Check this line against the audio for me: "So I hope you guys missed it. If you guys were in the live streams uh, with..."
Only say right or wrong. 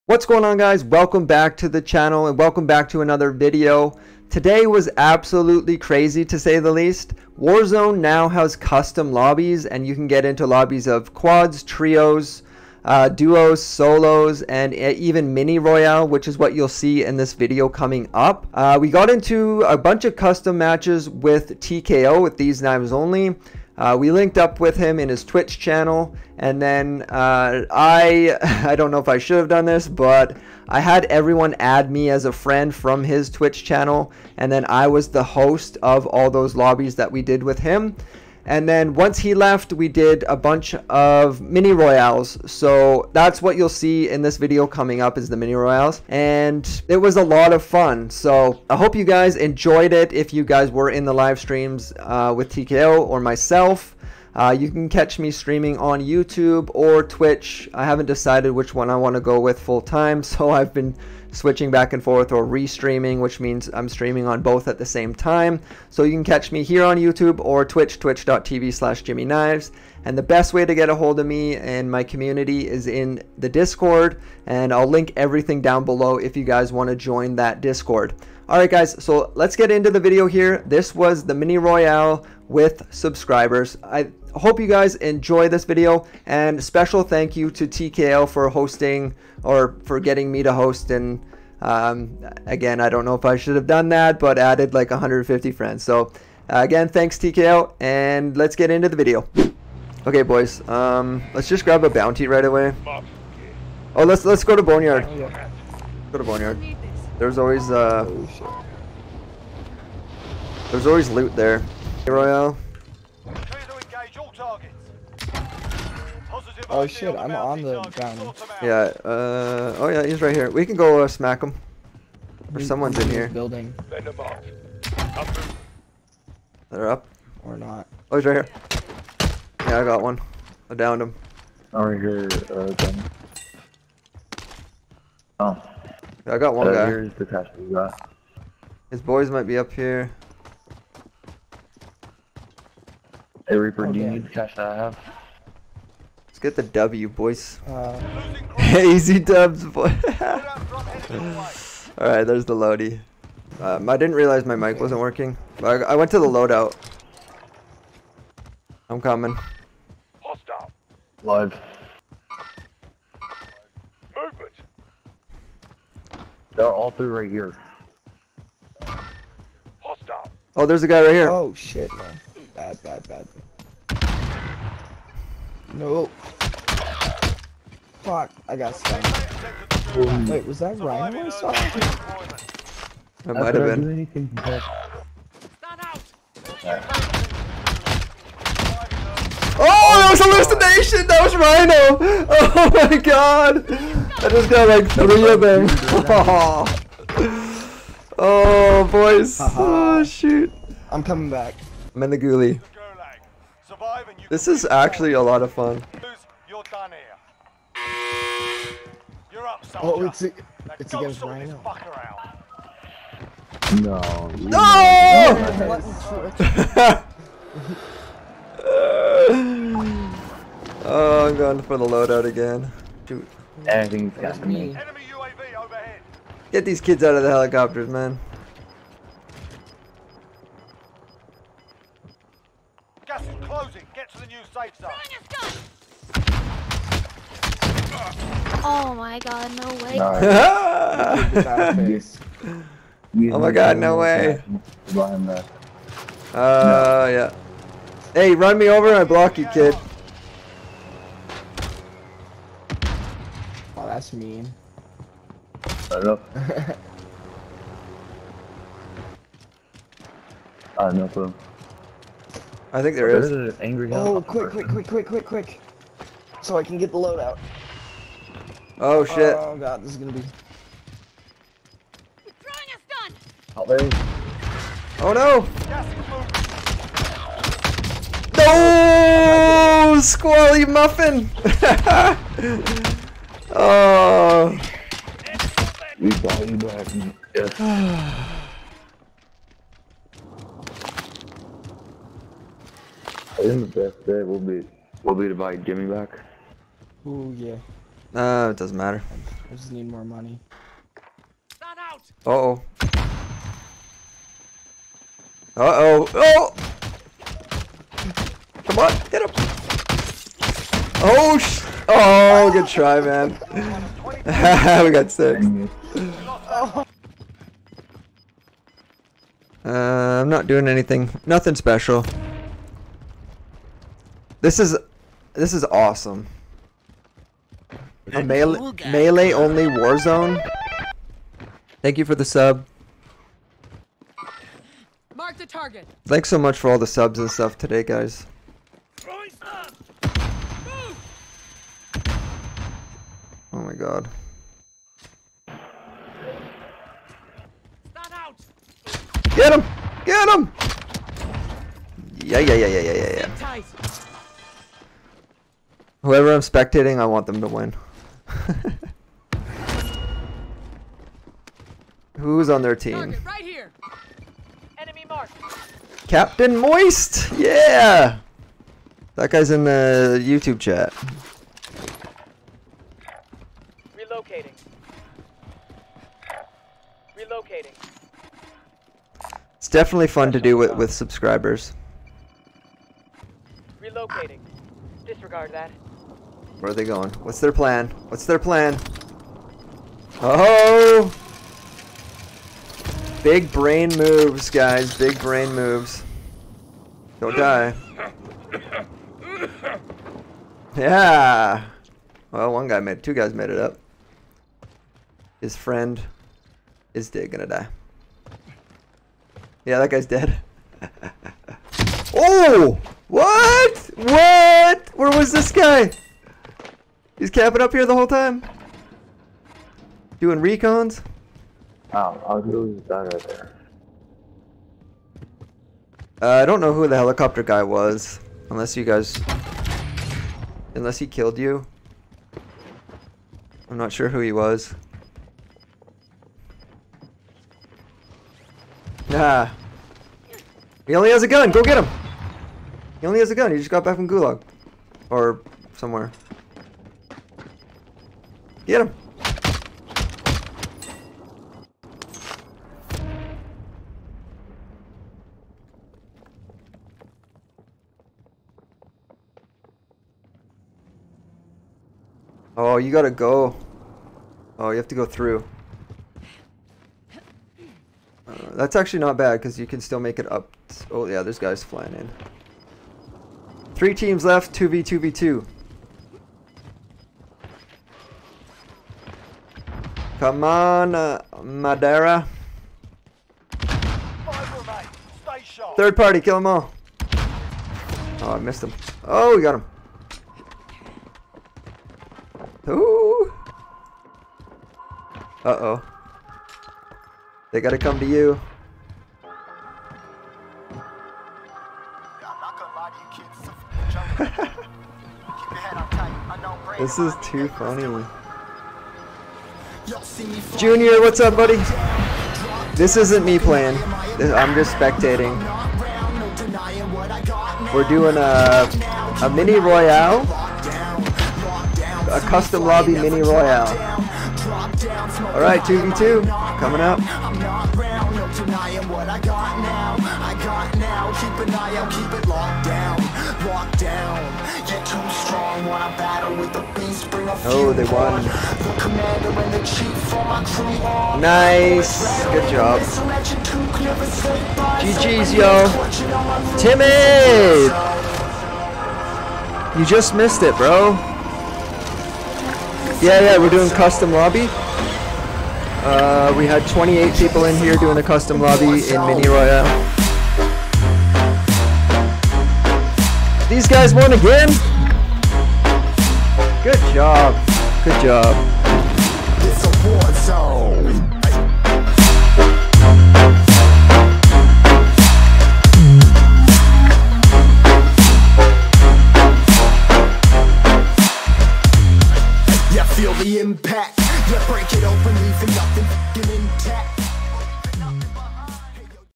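wrong.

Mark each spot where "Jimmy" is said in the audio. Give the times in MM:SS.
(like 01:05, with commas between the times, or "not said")
01:09, 04:55.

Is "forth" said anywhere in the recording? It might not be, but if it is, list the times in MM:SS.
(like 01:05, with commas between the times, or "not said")
01:02.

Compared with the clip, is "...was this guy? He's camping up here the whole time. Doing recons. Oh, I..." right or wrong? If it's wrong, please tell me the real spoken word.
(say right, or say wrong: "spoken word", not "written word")
right.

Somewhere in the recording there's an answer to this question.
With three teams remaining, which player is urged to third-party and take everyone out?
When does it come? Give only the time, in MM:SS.
08:01.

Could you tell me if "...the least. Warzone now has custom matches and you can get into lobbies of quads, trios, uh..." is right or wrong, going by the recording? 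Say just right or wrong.
wrong.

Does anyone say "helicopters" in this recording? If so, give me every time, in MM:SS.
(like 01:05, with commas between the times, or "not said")
03:47, 07:06.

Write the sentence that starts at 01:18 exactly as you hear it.
Alright guys, so let's get into the video here.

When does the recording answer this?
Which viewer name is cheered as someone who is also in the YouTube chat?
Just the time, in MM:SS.
06:06.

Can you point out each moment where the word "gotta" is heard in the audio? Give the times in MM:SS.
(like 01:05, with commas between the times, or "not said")
07:42, 08:17.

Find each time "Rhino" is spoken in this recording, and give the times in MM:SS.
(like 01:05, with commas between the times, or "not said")
03:00, 03:11, 03:31.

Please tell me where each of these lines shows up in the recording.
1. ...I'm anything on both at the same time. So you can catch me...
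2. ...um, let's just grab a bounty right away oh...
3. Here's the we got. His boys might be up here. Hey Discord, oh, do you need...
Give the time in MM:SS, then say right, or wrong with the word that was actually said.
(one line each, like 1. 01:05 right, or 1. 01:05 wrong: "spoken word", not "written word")
1. 01:03 wrong: "streaming", not "anything"
2. 01:40 right
3. 02:16 wrong: "Reaper", not "Discord".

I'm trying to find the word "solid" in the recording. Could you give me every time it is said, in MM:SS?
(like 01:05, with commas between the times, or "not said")
not said.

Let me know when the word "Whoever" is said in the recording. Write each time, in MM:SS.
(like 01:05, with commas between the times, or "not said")
05:56.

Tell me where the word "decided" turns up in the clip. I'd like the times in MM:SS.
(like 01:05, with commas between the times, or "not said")
00:58.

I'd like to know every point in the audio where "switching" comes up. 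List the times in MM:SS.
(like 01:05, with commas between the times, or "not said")
01:01.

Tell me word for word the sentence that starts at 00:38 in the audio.
And then once he left, we did a bunch of mini royales.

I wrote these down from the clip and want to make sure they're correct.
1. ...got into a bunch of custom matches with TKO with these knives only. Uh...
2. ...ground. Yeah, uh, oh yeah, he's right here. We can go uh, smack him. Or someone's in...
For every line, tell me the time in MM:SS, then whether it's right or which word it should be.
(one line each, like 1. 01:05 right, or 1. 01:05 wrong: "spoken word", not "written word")
1. 00:18 right
2. 01:57 right.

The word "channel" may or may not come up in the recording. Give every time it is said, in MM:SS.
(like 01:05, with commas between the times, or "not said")
00:01, 00:25, 00:33.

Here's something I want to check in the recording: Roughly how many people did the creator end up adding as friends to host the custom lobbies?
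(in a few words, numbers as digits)
150.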